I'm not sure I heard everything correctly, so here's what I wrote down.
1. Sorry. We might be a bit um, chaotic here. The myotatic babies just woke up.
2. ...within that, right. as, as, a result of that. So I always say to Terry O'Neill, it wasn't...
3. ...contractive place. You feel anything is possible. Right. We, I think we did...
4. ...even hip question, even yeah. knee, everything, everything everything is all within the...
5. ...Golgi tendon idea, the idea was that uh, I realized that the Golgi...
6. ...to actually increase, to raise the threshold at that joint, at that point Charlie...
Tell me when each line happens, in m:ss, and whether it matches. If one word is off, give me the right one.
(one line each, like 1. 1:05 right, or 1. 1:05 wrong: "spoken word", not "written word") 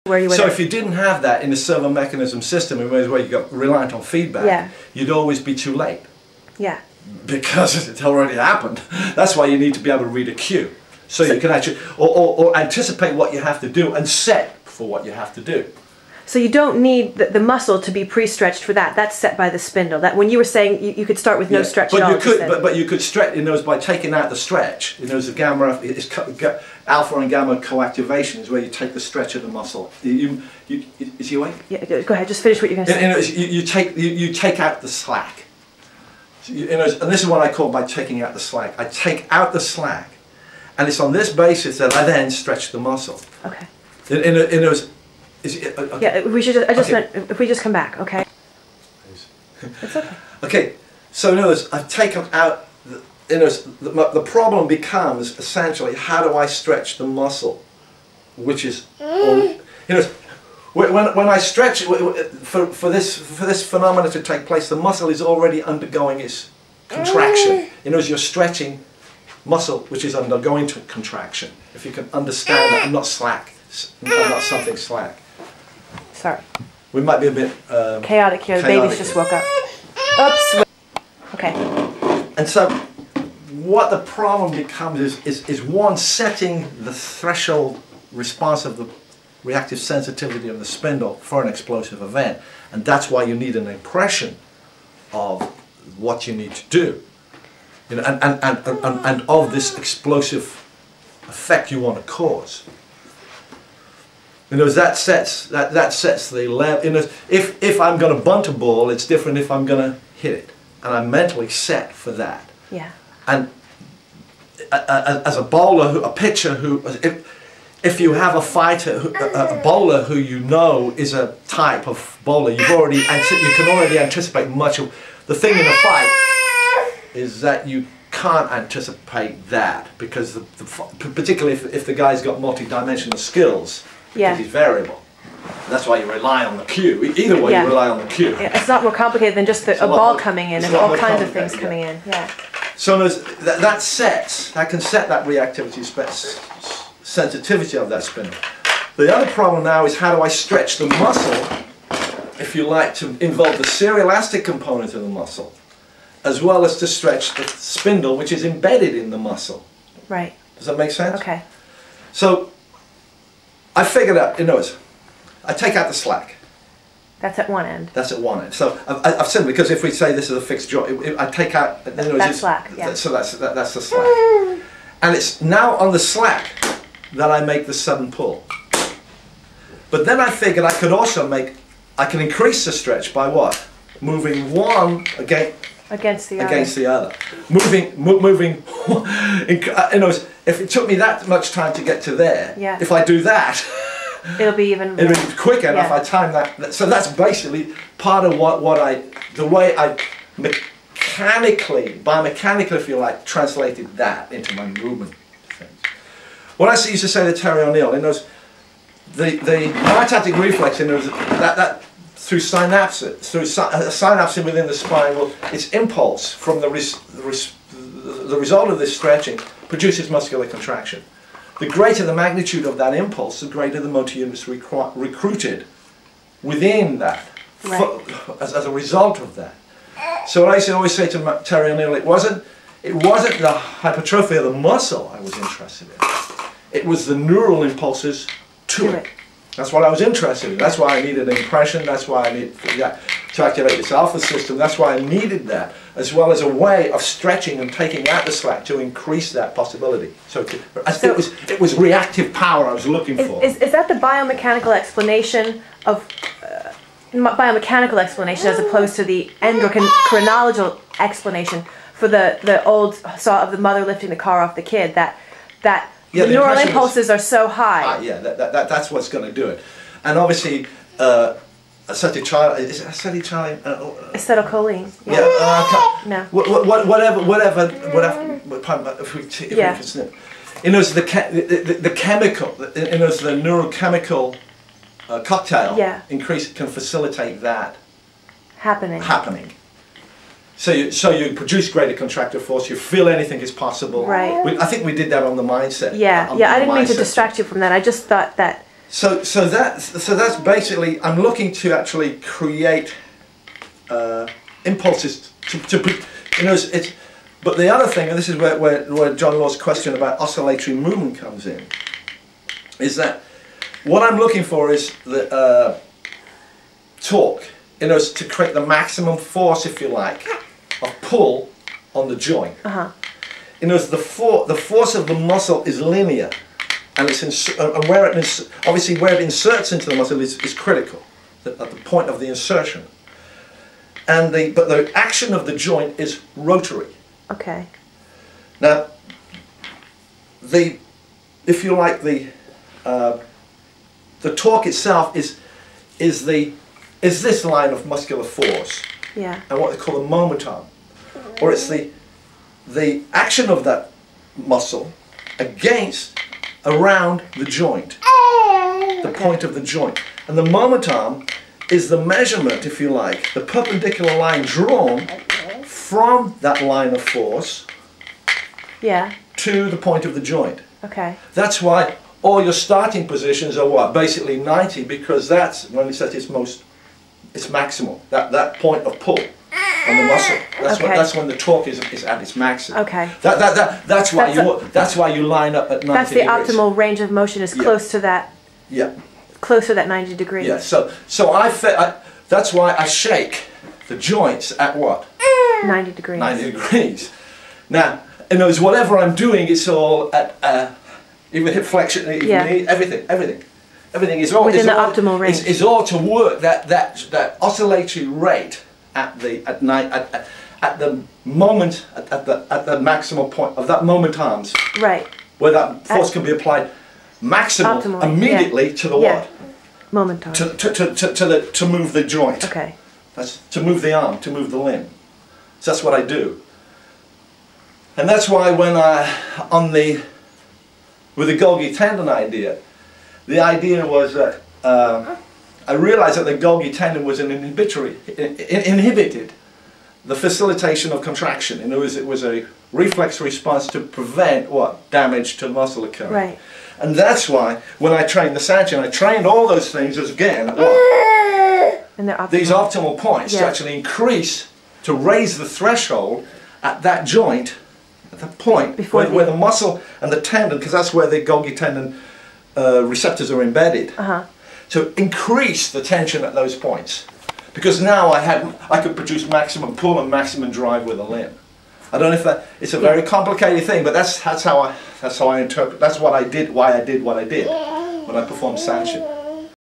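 1. 1:16 wrong: "chaotic", not "myotatic"
2. 3:46 right
3. 4:51 wrong: "force", not "place"
4. 6:41 wrong: "flexion", not "question"
5. 7:11 right
6. 7:33 wrong: "Before", not "Charlie".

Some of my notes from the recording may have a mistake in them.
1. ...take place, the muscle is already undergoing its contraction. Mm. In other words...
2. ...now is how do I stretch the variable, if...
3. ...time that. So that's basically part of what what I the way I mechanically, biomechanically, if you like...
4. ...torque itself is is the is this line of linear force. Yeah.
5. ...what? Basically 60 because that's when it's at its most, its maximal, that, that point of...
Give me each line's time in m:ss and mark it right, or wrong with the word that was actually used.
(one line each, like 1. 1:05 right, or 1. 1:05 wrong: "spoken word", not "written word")
1. 1:04 right
2. 2:29 wrong: "muscle", not "variable"
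3. 3:15 right
4. 5:44 wrong: "muscular", not "linear"
5. 6:13 wrong: "90", not "60".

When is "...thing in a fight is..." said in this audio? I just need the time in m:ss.
2:05.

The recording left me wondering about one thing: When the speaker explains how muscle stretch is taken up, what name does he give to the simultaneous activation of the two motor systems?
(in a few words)
alpha and gamma coactivation.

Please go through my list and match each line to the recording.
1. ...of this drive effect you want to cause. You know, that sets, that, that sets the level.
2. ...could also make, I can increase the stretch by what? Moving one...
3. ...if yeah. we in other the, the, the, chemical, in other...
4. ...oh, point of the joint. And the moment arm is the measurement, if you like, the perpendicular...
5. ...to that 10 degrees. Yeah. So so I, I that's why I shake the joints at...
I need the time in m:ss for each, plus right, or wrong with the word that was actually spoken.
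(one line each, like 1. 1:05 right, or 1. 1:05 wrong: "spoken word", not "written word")
1. 1:39 wrong: "explosive", not "drive"
2. 3:00 right
3. 4:39 right
4. 5:58 right
5. 6:29 wrong: "90", not "10".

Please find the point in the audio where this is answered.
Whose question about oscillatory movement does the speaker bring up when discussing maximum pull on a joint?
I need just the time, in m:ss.
5:09.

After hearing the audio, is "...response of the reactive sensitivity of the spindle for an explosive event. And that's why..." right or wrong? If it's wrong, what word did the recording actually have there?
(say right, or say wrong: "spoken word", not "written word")
right.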